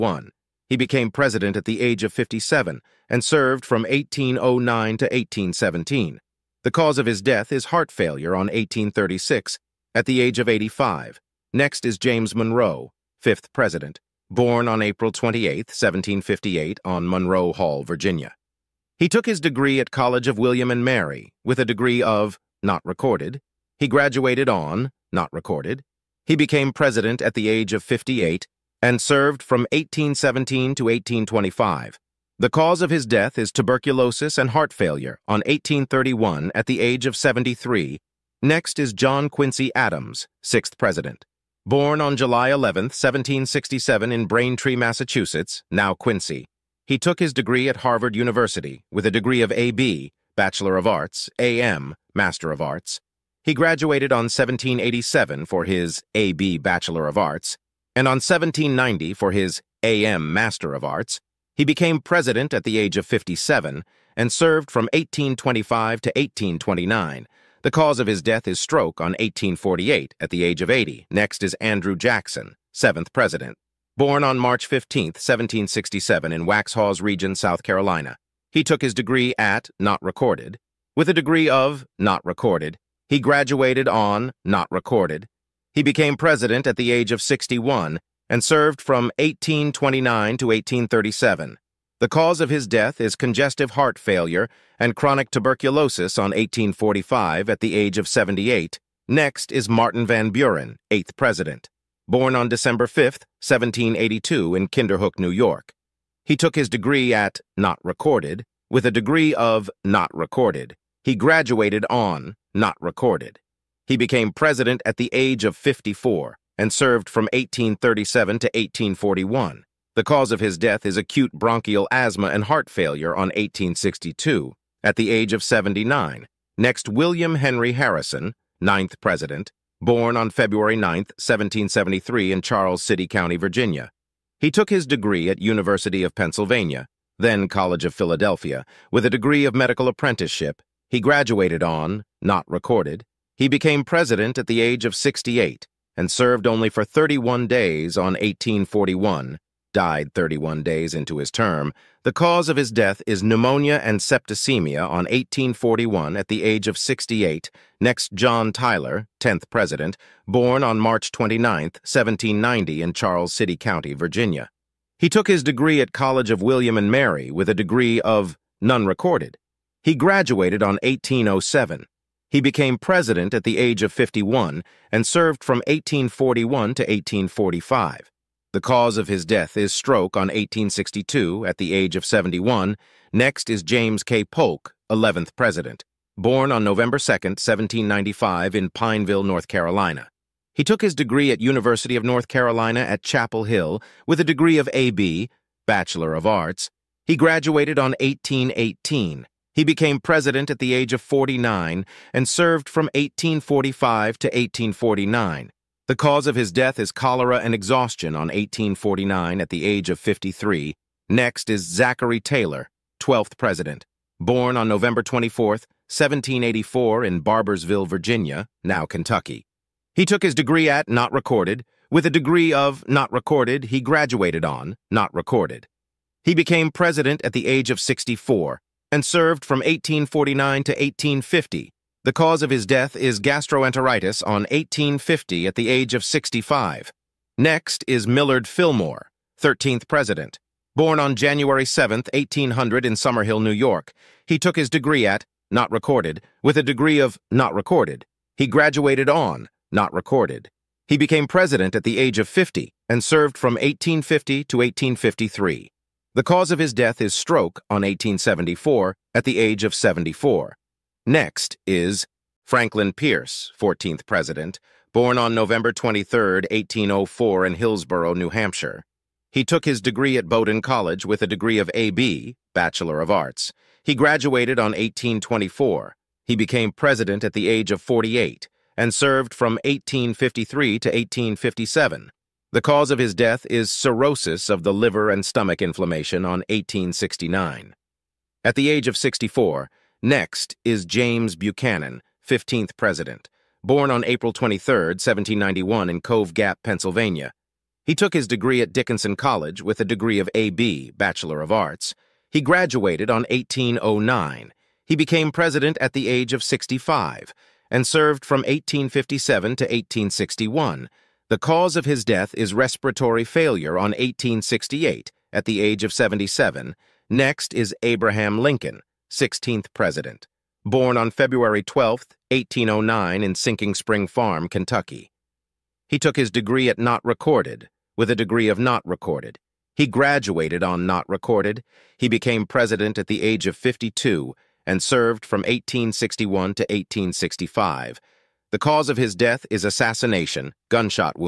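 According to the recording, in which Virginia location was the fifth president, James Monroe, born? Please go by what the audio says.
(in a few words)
Monroe Hall, Virginia.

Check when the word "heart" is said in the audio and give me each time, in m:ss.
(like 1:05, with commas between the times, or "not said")
0:07, 0:34, 1:33, 2:02.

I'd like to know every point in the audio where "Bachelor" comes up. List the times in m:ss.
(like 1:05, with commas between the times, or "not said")
0:50, 0:56, 3:15, 4:32, 5:00.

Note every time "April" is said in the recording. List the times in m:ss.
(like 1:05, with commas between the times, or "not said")
0:14, 4:54.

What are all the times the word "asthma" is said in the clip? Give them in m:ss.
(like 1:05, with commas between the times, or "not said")
2:01.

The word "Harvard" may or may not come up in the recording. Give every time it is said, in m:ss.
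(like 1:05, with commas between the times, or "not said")
0:47.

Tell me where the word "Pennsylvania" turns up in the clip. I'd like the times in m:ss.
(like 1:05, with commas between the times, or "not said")
2:16, 4:56.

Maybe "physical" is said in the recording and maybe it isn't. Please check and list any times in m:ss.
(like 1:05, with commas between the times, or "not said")
not said.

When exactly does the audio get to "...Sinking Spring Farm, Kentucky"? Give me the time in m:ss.
5:23.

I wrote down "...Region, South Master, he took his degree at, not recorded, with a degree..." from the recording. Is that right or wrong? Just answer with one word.
wrong.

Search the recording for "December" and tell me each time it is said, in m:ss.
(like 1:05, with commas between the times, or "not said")
1:42.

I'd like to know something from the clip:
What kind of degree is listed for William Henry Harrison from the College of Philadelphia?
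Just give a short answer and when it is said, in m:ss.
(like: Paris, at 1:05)
Medical apprenticeship, at 2:19.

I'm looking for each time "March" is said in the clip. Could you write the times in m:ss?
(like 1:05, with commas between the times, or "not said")
1:14, 2:40.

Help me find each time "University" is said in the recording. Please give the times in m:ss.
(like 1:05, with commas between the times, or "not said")
0:48, 2:15, 3:11.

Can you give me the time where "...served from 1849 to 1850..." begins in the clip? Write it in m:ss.
3:49.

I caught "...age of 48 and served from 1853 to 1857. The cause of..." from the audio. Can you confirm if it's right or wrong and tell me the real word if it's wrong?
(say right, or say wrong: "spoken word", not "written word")
right.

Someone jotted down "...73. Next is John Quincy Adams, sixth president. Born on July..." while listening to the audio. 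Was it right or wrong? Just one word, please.
right.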